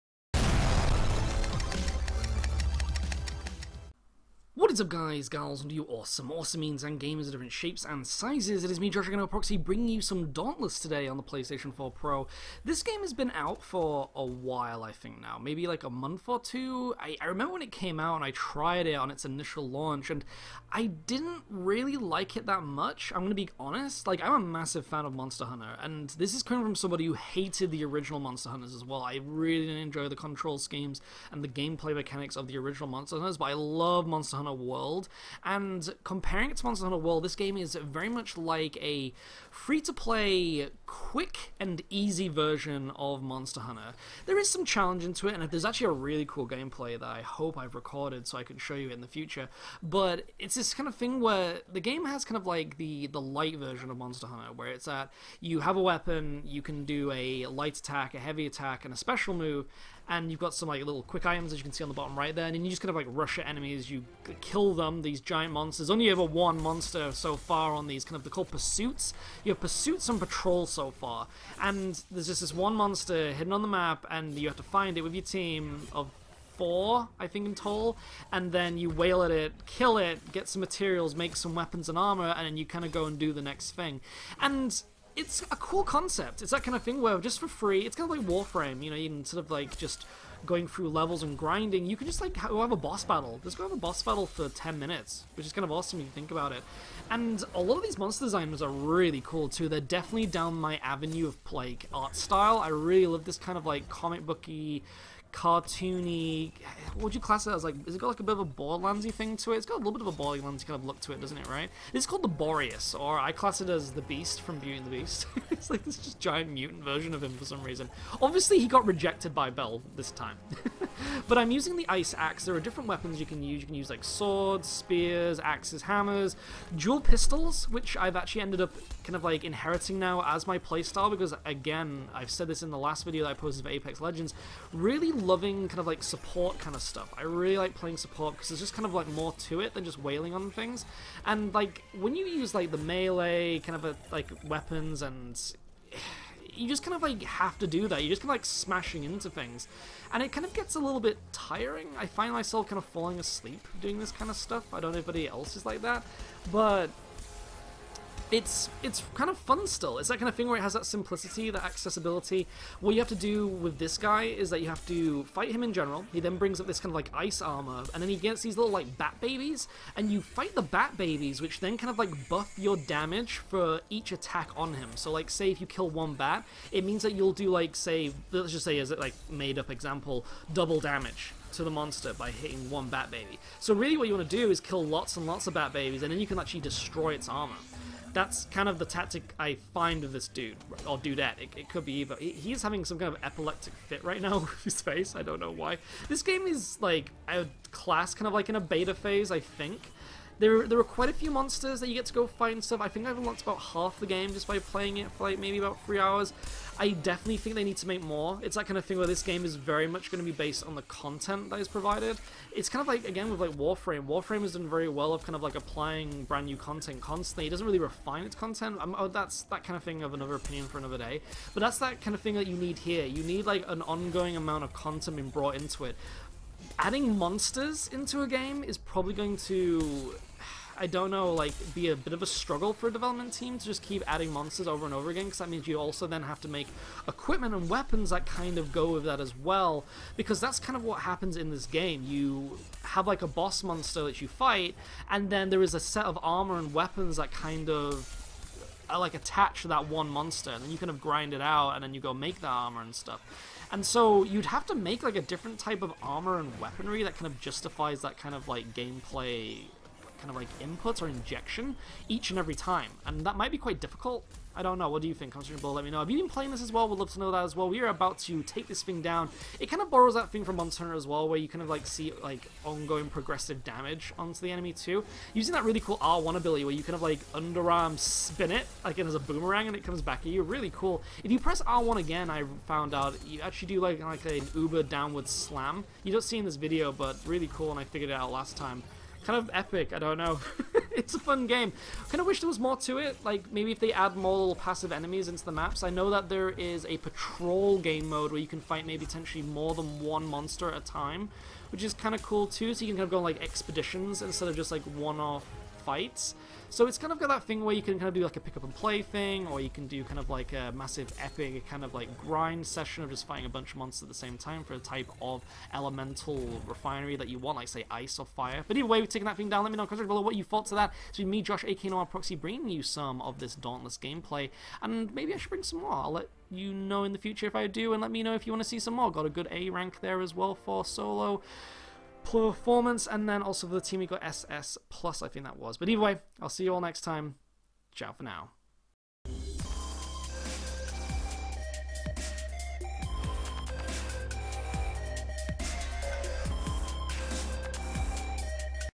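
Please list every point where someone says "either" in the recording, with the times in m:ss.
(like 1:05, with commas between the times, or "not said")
3:11, 5:18, 5:35.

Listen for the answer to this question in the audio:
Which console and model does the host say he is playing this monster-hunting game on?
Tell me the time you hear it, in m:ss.
0:11.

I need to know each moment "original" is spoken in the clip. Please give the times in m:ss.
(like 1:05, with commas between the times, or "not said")
0:27, 0:32.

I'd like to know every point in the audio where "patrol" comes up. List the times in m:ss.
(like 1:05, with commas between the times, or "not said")
1:10, 4:56.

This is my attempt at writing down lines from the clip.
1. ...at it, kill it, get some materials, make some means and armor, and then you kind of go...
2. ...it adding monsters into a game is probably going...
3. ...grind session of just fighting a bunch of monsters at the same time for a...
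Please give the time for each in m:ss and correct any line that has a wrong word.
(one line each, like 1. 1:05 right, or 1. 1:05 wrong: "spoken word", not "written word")
1. 1:19 wrong: "weapons", not "means"
2. 3:45 right
3. 5:12 right.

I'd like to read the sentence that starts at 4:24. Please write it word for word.
What do you think, Constantine Bull?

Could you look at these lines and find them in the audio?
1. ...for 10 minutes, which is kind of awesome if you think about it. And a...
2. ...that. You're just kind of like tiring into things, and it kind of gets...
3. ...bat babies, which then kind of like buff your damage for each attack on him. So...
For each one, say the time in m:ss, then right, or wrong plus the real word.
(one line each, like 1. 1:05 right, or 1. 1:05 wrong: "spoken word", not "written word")
1. 1:34 right
2. 2:27 wrong: "smashing", not "tiring"
3. 2:50 right.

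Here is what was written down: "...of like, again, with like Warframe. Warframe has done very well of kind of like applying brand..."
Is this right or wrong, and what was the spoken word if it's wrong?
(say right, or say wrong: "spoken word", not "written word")
right.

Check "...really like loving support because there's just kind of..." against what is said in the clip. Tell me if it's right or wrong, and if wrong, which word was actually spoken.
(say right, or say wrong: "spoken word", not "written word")
wrong: "playing", not "loving".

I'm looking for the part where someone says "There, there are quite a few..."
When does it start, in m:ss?
3:20.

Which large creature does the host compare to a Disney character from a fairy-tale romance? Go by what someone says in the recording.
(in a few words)
Boreus.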